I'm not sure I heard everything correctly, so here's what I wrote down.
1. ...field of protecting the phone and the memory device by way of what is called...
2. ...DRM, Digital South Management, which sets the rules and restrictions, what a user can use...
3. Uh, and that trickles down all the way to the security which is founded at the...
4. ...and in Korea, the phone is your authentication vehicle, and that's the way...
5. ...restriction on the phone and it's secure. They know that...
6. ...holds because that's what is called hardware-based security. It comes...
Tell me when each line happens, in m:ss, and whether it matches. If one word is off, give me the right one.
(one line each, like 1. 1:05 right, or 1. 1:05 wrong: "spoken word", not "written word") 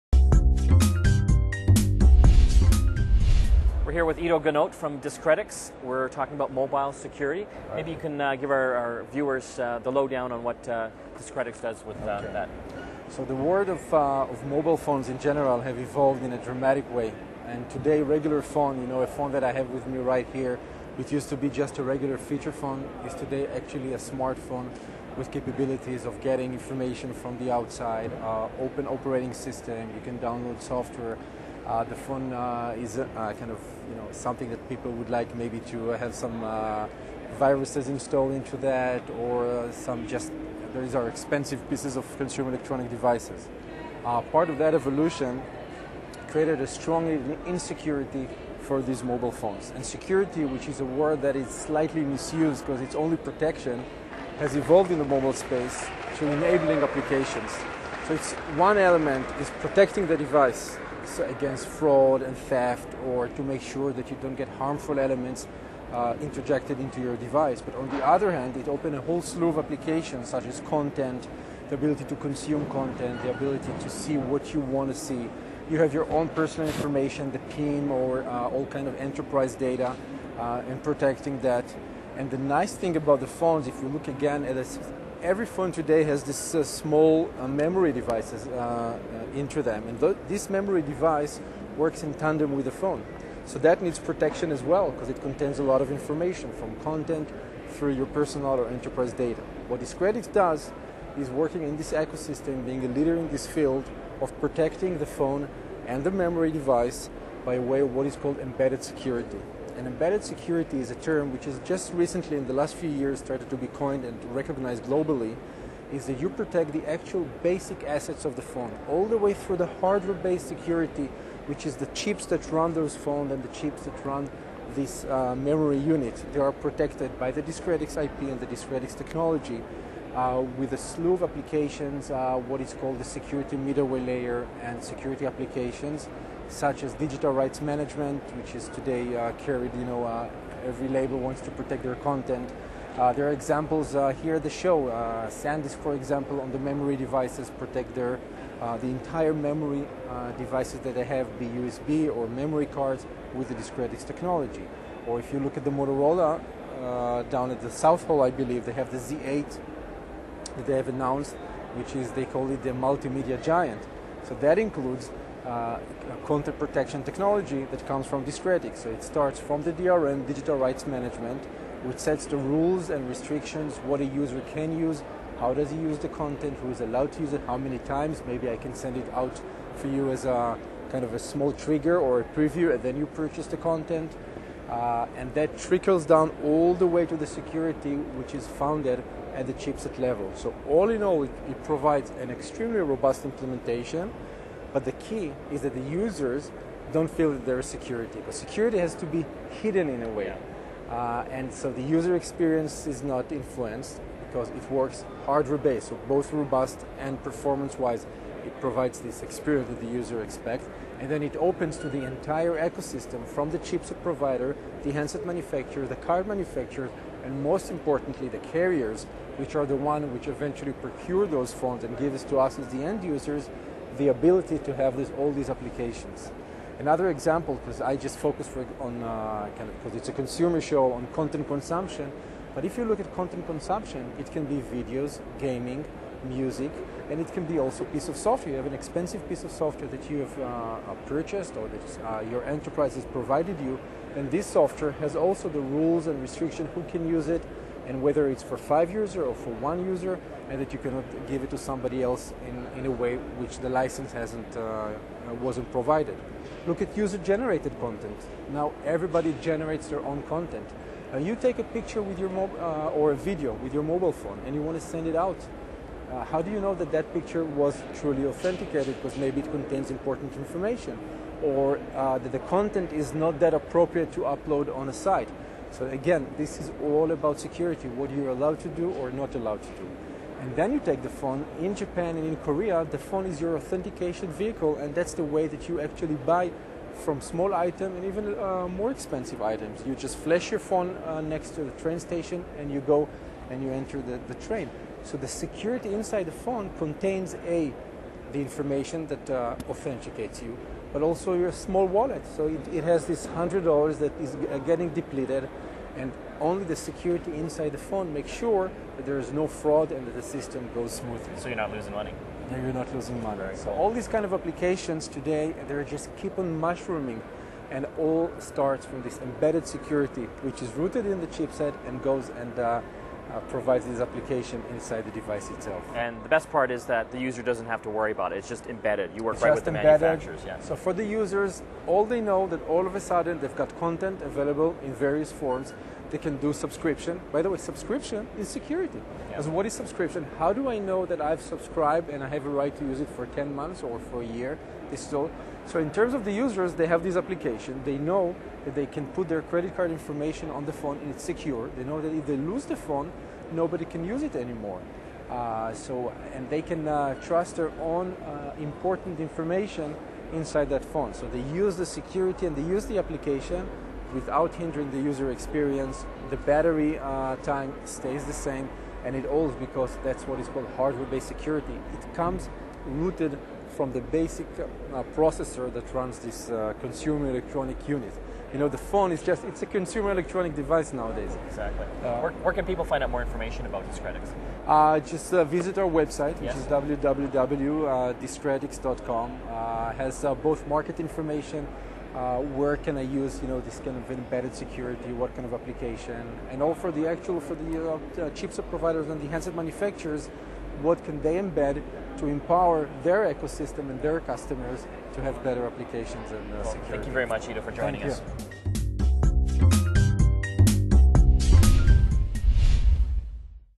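1. 1:43 right
2. 2:49 wrong: "Rights", not "South"
3. 3:04 right
4. 4:42 right
5. 5:49 wrong: "information", not "restriction"
6. 6:09 right.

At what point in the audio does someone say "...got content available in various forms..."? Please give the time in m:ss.
5:33.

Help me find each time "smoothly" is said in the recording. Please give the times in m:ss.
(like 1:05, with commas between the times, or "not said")
5:10.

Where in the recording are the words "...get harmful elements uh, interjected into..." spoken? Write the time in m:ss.
1:04.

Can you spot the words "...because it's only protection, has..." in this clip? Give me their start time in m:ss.
0:52.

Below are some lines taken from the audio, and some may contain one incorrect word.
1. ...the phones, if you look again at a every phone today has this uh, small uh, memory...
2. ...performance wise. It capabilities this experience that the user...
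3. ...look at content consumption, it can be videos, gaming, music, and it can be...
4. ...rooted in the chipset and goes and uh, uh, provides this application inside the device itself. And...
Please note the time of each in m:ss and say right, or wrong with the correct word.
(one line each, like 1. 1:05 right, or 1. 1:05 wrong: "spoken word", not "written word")
1. 1:23 right
2. 3:27 wrong: "provides", not "capabilities"
3. 3:52 right
4. 5:20 right.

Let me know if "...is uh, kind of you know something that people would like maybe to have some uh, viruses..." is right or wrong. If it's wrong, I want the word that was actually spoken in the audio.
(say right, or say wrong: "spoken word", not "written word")
right.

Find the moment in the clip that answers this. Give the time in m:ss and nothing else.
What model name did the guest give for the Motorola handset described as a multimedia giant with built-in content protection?
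2:38.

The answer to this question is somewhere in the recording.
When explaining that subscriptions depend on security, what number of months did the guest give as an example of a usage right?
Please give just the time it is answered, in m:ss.
5:43.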